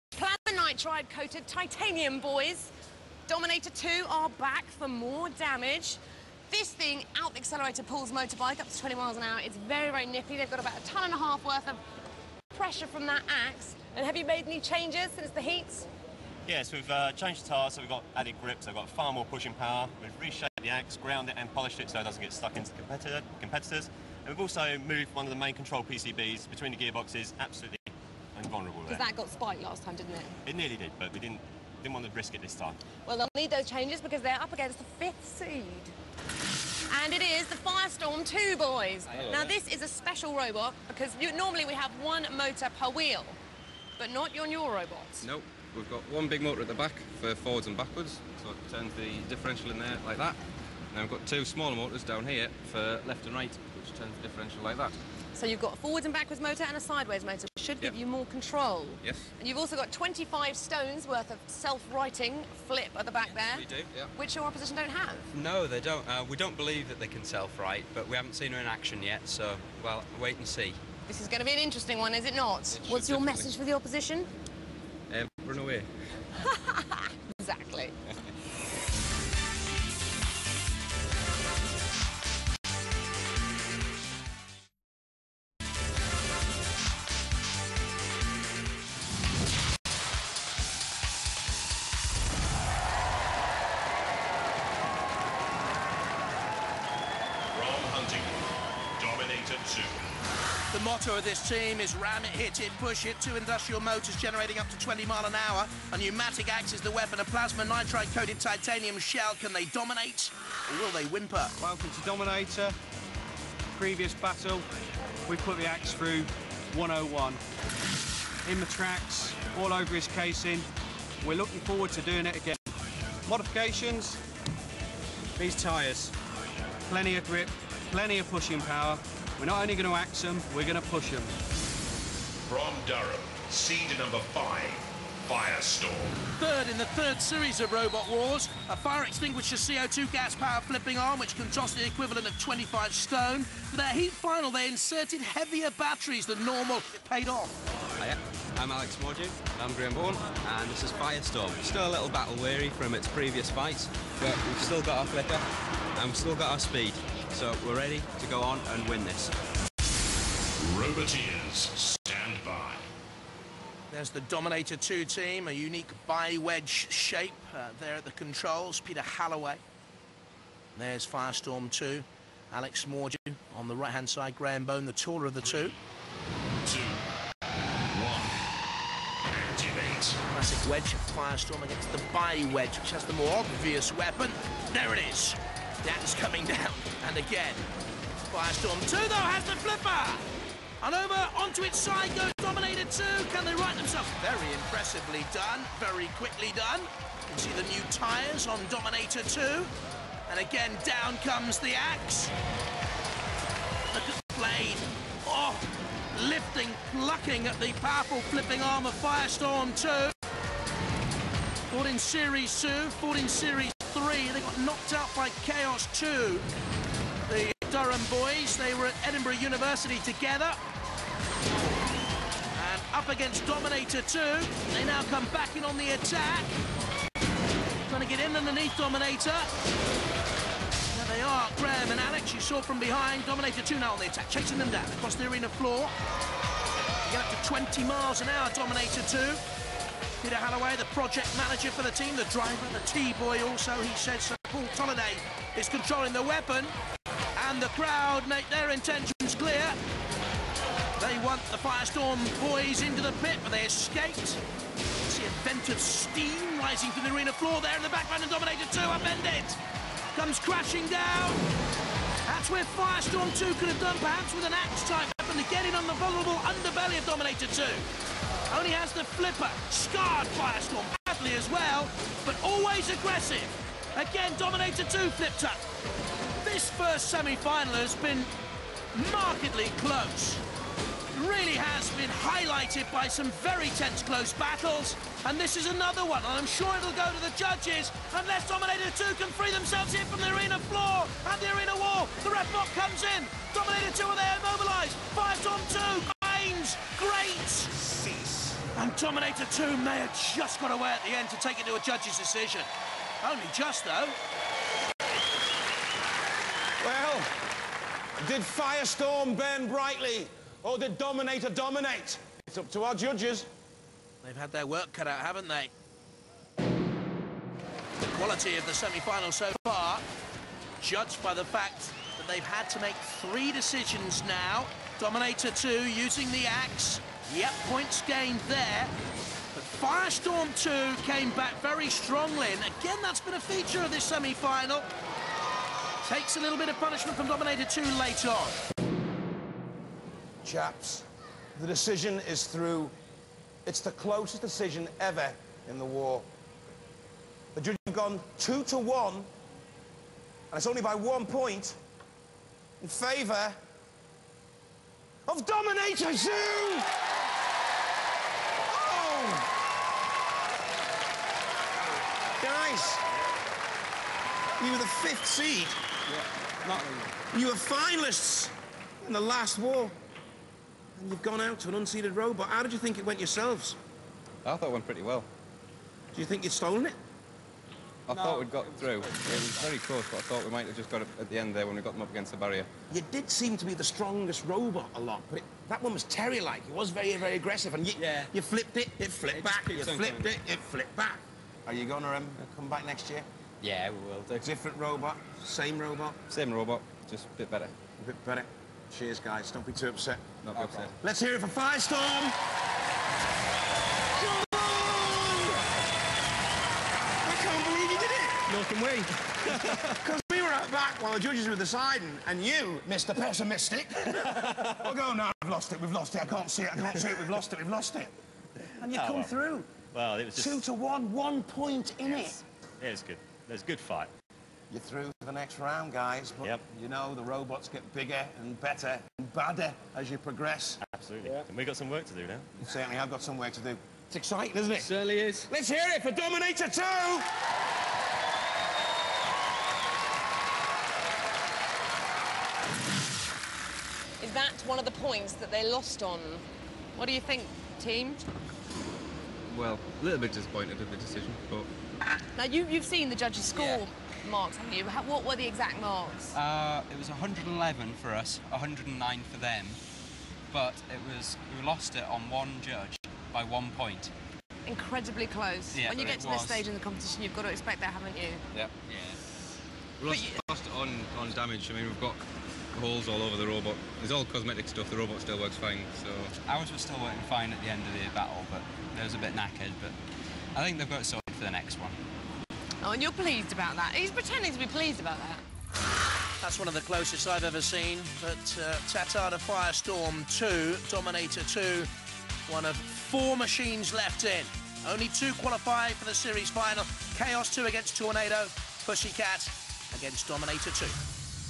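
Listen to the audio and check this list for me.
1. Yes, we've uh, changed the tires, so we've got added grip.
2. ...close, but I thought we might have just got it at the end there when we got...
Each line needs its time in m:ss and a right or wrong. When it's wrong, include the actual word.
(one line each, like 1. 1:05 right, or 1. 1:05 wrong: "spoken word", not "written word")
1. 0:16 right
2. 6:19 right.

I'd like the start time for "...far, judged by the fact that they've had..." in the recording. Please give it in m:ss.
5:19.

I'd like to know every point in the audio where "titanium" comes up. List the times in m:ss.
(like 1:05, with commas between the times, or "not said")
0:01, 1:48.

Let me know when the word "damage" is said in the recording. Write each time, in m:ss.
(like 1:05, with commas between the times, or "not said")
0:05, 7:51.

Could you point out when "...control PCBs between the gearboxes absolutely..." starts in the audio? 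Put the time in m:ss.
0:25.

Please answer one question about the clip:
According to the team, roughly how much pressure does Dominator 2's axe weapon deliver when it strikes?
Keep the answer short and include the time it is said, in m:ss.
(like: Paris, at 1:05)
a ton and a half, at 0:10.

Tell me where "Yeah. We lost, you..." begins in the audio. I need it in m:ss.
7:48.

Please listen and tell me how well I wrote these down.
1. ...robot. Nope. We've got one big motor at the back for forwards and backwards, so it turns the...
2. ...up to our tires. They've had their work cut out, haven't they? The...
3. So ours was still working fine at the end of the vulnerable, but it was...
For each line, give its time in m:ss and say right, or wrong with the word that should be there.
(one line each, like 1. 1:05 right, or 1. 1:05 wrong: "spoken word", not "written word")
1. 0:44 right
2. 5:12 wrong: "judges", not "tires"
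3. 7:55 wrong: "battle", not "vulnerable".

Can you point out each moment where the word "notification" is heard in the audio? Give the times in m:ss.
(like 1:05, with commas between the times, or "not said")
not said.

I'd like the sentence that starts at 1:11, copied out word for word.
This is going to be an interesting one, is it not?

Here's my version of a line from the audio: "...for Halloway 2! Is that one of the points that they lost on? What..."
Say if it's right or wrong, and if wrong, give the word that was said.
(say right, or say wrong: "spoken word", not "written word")
wrong: "Dominator", not "Halloway".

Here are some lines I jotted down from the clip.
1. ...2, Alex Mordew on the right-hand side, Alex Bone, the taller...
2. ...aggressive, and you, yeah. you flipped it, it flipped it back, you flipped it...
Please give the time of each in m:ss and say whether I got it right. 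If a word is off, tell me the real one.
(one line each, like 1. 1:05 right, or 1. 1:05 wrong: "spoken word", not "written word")
1. 2:51 wrong: "Graham", not "Alex"
2. 6:27 right.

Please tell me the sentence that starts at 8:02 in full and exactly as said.
Oh, and you're pleased about that.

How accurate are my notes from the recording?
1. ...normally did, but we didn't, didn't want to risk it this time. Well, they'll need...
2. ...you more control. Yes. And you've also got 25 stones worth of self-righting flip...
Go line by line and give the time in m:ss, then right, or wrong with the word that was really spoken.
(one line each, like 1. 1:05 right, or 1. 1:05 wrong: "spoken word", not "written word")
1. 0:30 wrong: "nearly", not "normally"
2. 0:57 right.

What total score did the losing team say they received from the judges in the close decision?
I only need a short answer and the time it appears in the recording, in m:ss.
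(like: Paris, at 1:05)
111, at 7:37.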